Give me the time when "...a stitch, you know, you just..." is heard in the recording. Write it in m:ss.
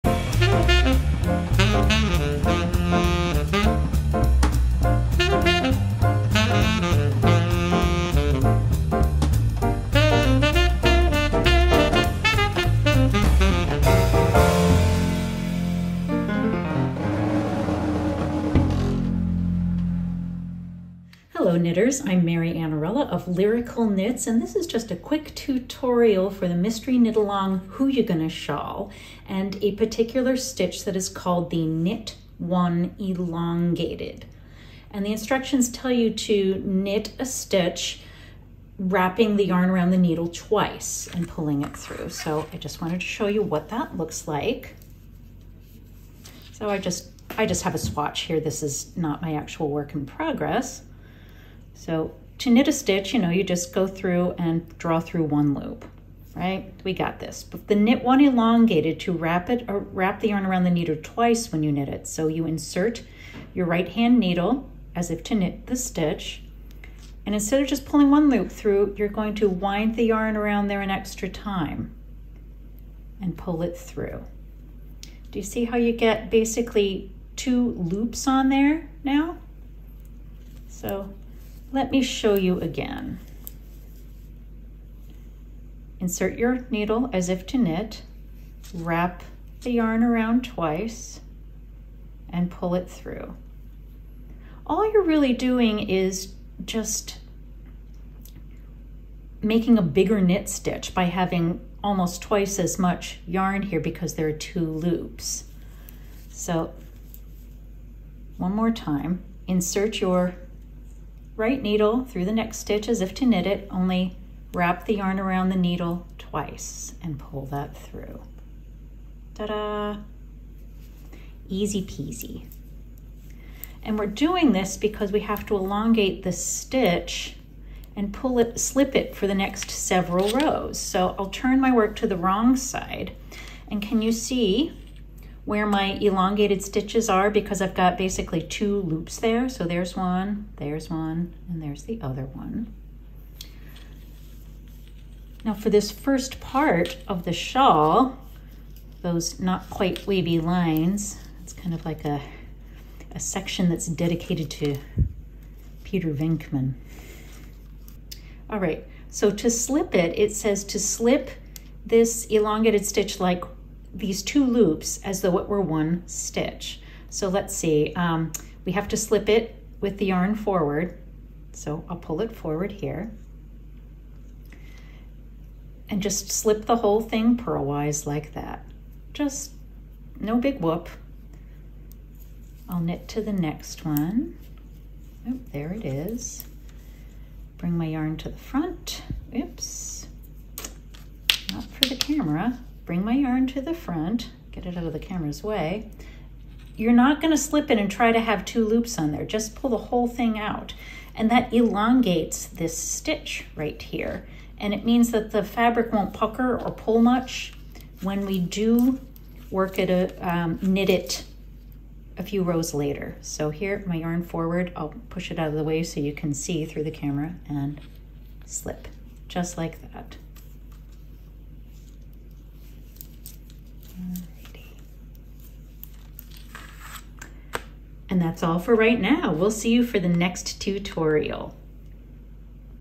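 0:52.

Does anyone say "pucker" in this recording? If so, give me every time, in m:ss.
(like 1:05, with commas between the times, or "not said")
3:26.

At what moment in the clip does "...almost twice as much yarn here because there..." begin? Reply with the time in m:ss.
1:41.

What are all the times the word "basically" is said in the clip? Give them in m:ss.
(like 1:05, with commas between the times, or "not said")
1:16, 2:17.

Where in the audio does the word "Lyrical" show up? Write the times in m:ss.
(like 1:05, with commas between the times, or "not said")
0:23.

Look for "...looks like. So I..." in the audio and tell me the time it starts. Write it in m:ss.
0:43.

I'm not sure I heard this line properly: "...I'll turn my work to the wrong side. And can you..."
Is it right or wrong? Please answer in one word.
right.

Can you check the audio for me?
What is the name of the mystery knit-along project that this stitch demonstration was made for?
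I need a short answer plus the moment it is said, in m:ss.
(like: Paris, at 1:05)
Who You Gonna Shawl, at 0:27.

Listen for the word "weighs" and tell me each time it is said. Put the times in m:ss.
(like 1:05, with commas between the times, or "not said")
not said.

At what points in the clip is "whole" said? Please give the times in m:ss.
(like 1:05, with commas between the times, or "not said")
2:56, 3:19.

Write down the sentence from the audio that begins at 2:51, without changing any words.
So I'll pull it forward here.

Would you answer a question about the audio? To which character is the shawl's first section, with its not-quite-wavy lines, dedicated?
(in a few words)
Peter Venkman.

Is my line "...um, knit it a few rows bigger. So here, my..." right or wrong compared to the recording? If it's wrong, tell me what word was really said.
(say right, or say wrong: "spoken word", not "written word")
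wrong: "later", not "bigger".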